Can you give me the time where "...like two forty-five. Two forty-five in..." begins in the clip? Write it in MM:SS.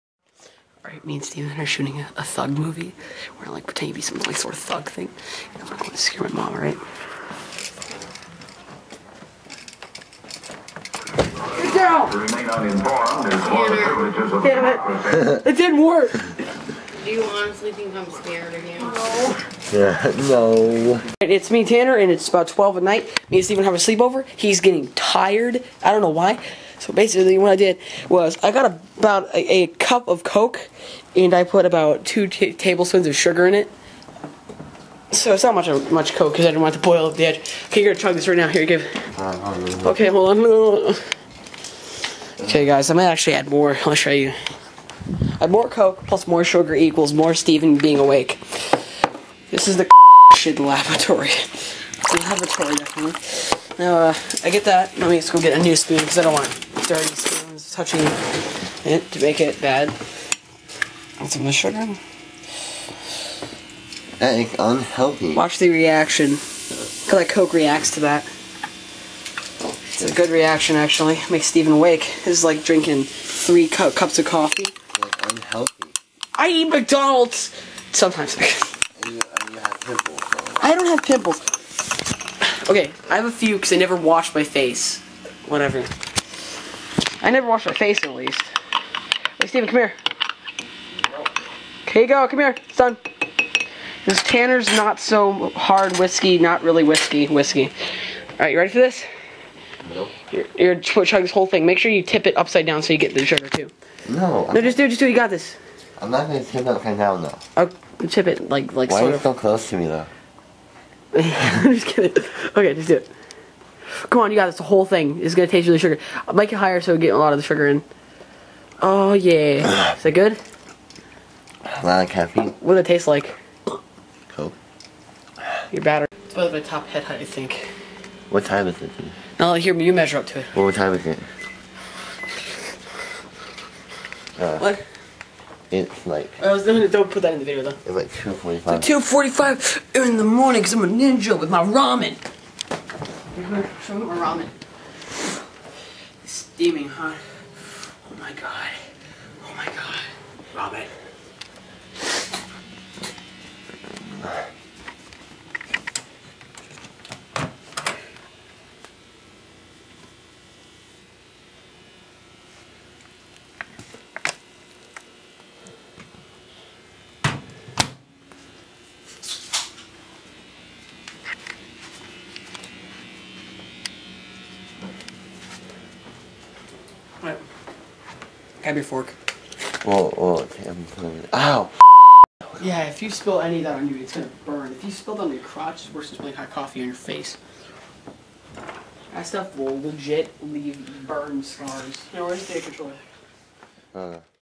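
02:17.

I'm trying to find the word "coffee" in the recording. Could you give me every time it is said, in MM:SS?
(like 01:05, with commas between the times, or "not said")
01:14, 03:06.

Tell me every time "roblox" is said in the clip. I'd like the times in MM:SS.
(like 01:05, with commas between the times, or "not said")
not said.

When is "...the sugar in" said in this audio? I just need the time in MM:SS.
01:57.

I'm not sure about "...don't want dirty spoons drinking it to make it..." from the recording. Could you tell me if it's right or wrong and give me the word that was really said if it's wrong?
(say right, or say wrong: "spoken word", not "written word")
wrong: "touching", not "drinking".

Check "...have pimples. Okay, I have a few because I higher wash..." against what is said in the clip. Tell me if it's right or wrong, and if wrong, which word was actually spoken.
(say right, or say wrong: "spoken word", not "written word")
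wrong: "never", not "higher".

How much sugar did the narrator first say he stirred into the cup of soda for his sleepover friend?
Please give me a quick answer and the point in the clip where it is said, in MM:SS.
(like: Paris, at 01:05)
2 tablespoons, at 00:32.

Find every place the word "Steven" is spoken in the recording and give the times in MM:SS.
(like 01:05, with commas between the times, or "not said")
00:01, 00:23, 00:47, 01:11, 01:29.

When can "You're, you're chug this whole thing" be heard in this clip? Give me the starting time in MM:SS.
01:40.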